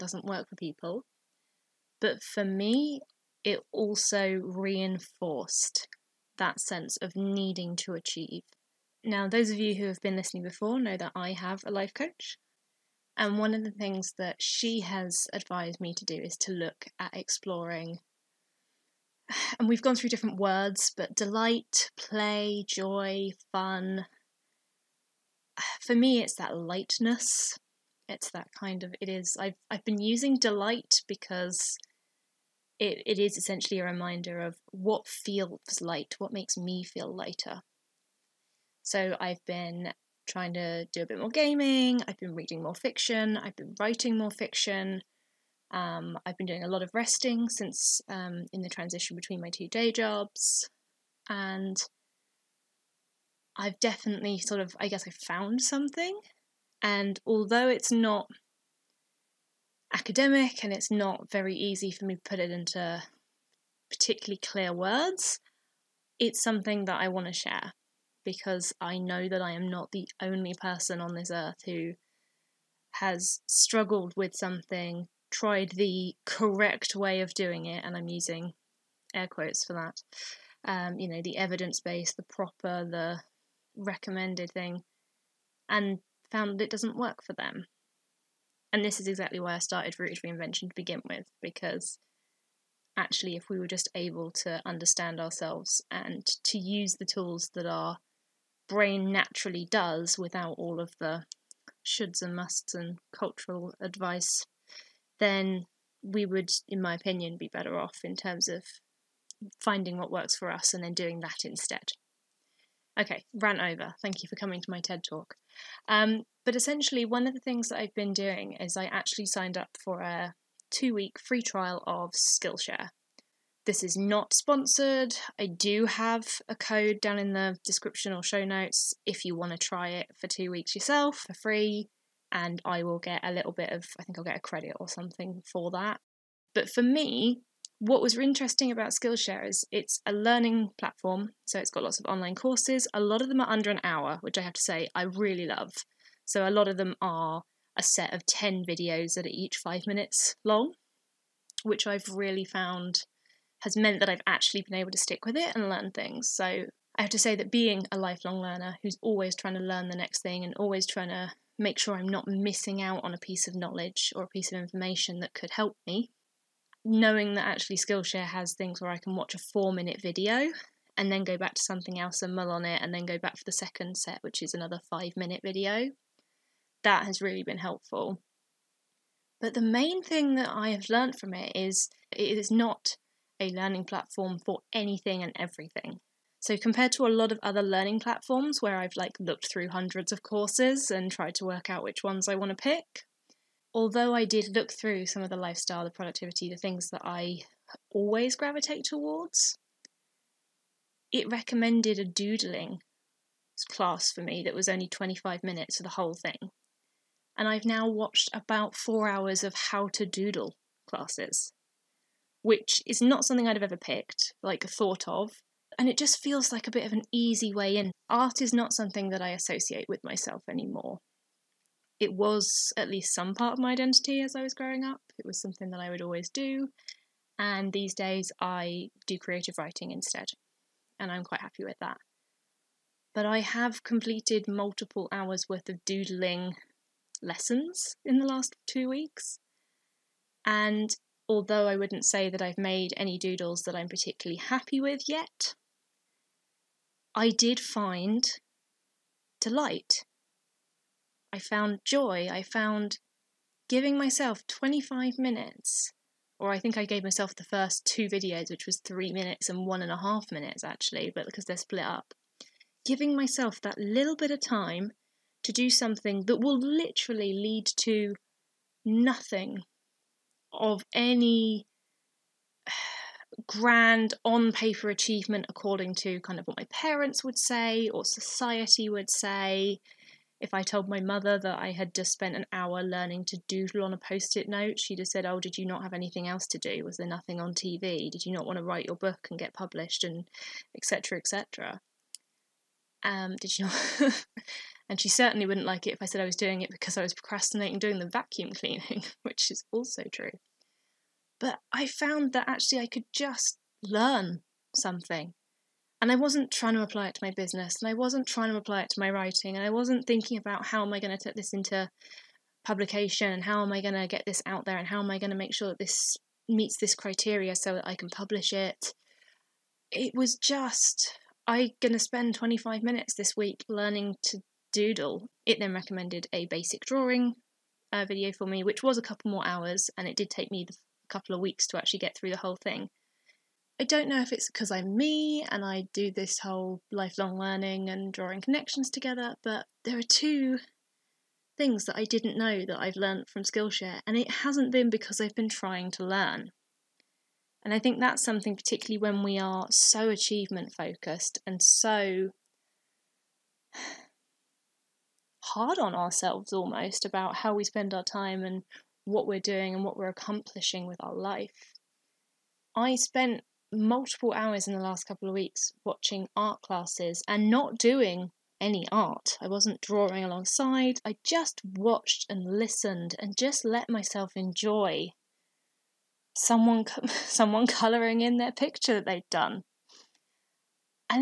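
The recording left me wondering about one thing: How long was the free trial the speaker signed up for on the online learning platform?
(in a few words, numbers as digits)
2 weeks.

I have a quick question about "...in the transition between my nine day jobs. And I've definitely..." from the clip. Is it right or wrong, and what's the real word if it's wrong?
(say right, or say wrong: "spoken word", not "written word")
wrong: "two", not "nine".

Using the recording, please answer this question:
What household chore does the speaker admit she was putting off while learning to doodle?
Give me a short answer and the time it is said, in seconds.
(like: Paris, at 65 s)
Vacuum cleaning, at 298 s.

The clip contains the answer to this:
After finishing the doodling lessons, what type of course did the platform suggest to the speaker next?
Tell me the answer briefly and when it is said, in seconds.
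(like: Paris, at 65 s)
Basic drawing, at 326 s.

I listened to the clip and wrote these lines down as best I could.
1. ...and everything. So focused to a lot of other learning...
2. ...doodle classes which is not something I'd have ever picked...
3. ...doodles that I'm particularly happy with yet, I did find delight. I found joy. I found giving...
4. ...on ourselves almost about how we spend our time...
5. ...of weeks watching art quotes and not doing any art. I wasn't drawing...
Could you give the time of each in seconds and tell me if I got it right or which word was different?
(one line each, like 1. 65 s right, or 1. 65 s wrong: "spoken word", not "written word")
1. 185 s wrong: "compared", not "focused"
2. 210 s right
3. 243 s right
4. 355 s right
5. 365 s wrong: "classes", not "quotes".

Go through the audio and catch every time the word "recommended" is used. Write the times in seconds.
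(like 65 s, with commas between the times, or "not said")
83 s, 201 s, 325 s.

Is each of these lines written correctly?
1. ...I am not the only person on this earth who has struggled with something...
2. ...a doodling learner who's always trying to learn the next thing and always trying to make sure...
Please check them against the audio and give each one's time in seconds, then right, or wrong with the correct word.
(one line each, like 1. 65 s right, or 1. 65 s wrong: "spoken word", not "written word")
1. 69 s right
2. 157 s wrong: "lifelong", not "doodling".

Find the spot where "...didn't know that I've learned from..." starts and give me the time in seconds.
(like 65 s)
342 s.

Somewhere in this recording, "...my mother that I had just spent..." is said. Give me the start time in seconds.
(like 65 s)
280 s.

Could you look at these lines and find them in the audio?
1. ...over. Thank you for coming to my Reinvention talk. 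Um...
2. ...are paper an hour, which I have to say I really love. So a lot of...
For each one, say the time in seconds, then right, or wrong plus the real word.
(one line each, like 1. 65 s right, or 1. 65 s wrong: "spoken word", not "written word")
1. 113 s wrong: "TED", not "Reinvention"
2. 143 s wrong: "under", not "paper".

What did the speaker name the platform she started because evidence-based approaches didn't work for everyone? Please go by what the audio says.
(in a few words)
Rooted Reinvention.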